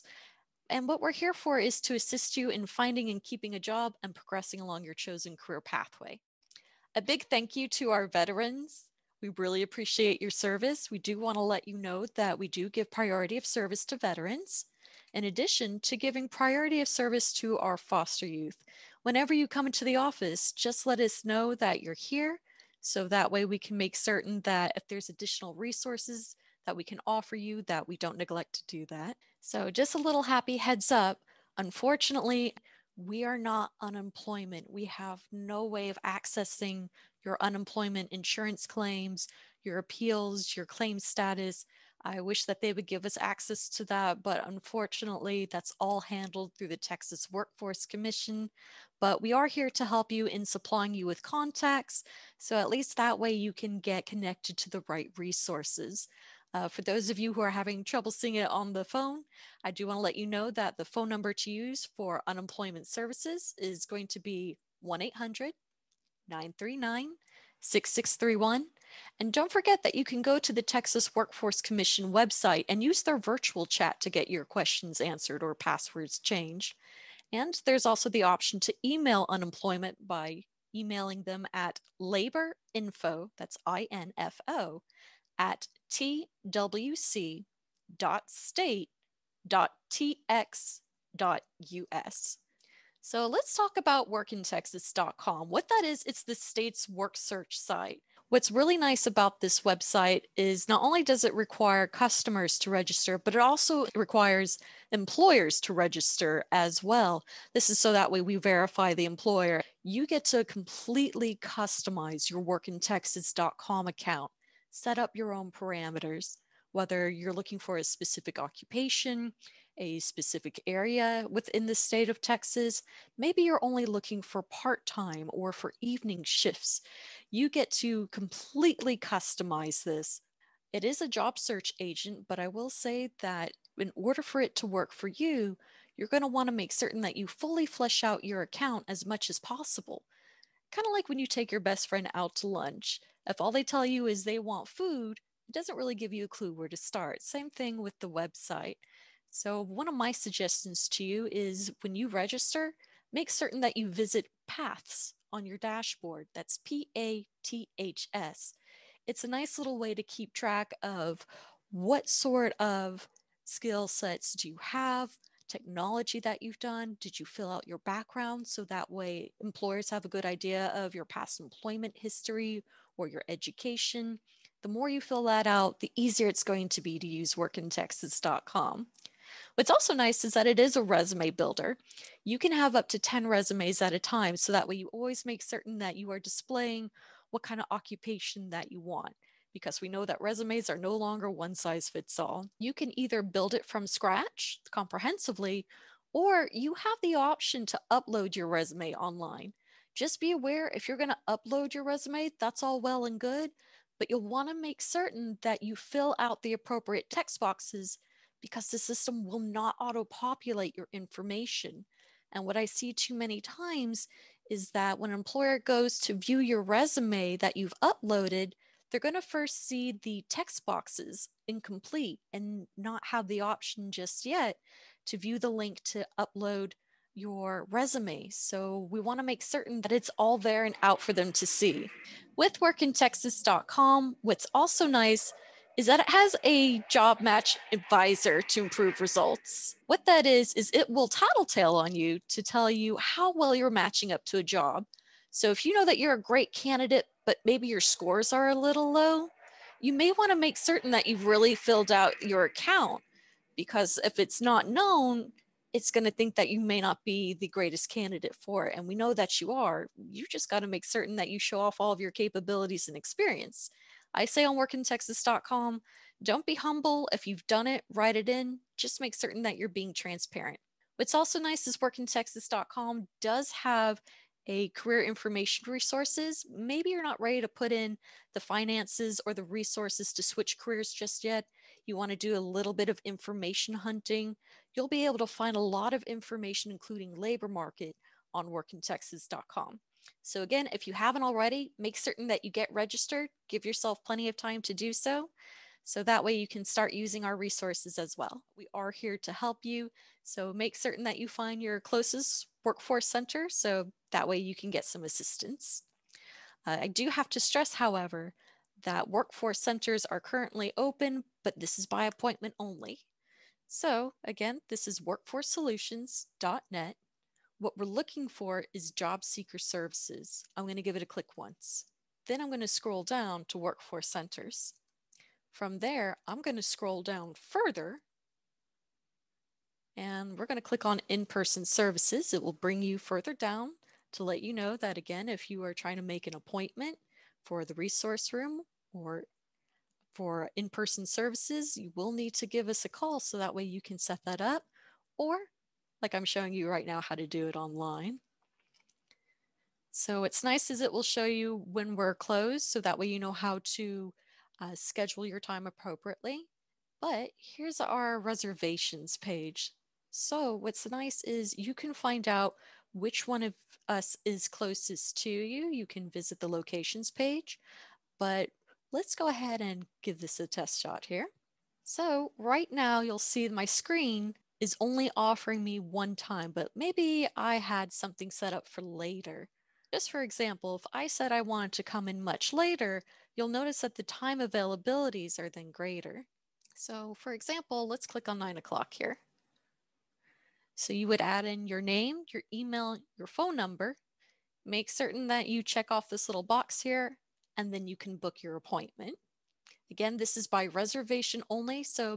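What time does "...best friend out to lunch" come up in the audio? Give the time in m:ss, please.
2:21.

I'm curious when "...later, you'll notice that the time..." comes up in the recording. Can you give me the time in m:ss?
6:22.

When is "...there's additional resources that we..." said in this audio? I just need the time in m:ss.
0:24.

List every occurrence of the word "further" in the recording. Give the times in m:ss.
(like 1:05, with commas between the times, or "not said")
5:27, 5:32.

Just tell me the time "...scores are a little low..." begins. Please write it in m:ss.
4:07.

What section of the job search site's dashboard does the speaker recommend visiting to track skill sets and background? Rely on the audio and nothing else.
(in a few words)
Paths.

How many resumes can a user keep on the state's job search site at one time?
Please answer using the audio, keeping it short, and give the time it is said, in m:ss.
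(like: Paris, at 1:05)
10, at 3:02.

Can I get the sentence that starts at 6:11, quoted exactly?
So, right now, you'll see my screen is only offering me one time, but maybe I had something set up for later.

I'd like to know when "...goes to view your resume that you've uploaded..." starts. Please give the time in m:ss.
3:35.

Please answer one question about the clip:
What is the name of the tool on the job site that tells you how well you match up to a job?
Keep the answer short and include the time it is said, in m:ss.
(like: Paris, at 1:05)
job match advisor, at 3:56.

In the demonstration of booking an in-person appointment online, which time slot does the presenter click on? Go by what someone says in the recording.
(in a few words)
9 o'clock.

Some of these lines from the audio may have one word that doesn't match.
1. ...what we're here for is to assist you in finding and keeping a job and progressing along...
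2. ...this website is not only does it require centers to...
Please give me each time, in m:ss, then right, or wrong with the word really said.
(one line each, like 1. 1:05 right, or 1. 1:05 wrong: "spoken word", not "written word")
1. 0:00 right
2. 1:39 wrong: "customers", not "centers".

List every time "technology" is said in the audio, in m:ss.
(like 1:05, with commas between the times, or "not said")
2:45.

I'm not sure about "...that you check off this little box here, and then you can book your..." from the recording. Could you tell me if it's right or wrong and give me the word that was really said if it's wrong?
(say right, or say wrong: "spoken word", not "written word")
right.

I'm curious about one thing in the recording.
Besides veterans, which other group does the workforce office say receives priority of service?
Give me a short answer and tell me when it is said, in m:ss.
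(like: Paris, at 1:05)
foster youth, at 0:17.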